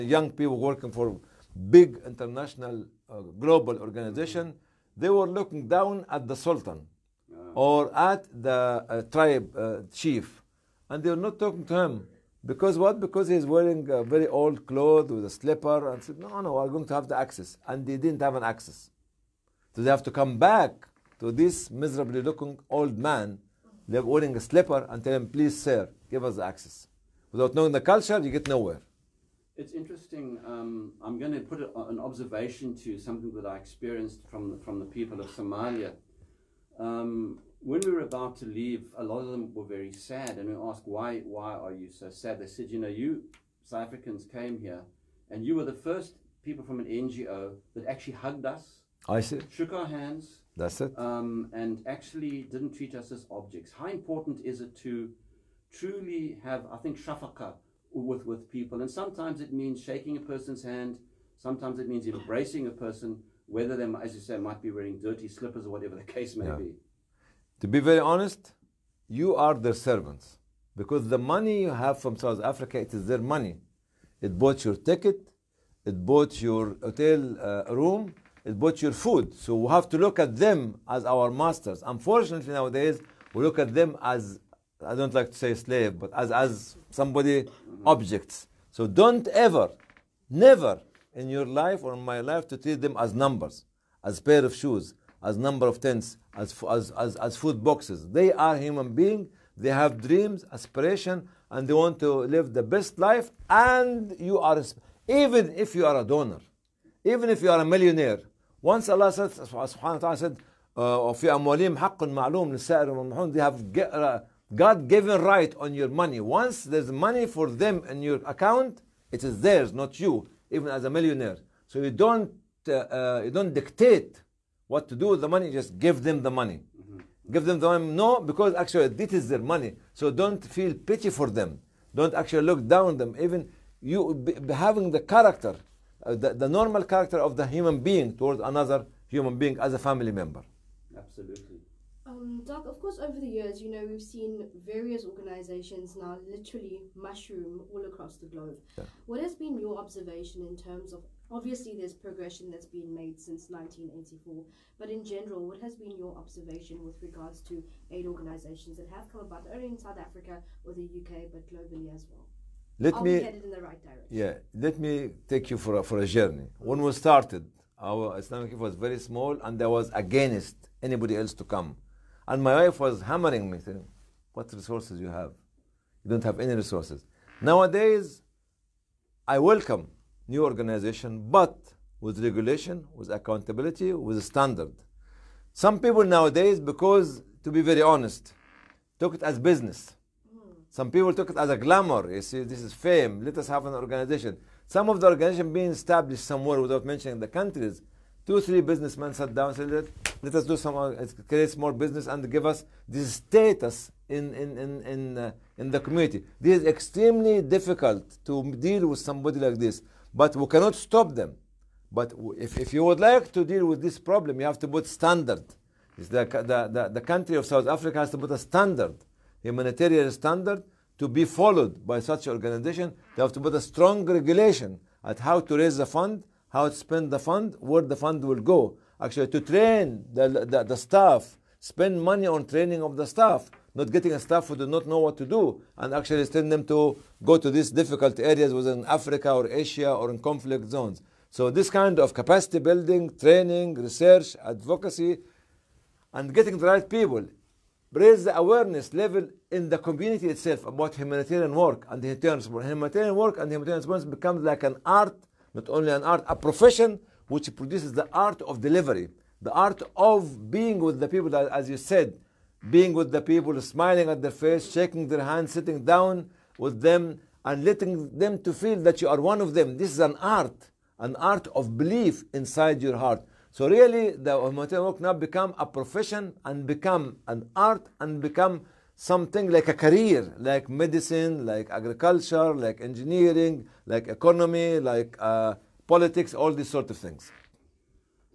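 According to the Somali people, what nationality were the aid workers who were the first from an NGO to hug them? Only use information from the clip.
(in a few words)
South Africans.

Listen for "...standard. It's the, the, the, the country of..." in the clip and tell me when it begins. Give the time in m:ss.
3:34.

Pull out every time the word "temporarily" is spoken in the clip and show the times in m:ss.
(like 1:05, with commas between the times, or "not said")
not said.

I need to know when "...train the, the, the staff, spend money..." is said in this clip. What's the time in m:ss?
3:49.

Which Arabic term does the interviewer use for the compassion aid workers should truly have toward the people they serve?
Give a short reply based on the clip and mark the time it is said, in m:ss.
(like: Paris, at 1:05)
shafaka, at 0:56.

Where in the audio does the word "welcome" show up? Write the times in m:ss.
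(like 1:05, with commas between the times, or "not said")
2:59.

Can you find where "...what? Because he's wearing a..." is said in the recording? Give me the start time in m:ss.
0:12.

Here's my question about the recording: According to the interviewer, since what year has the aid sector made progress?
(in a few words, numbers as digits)
1984.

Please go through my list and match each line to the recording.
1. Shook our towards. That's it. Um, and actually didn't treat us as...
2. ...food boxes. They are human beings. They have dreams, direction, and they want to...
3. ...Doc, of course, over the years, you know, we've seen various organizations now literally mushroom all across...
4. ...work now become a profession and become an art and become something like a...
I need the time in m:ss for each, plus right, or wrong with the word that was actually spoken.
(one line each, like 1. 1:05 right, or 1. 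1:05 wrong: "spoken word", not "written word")
1. 0:49 wrong: "hands", not "towards"
2. 1:37 wrong: "aspiration", not "direction"
3. 2:22 right
4. 4:34 right.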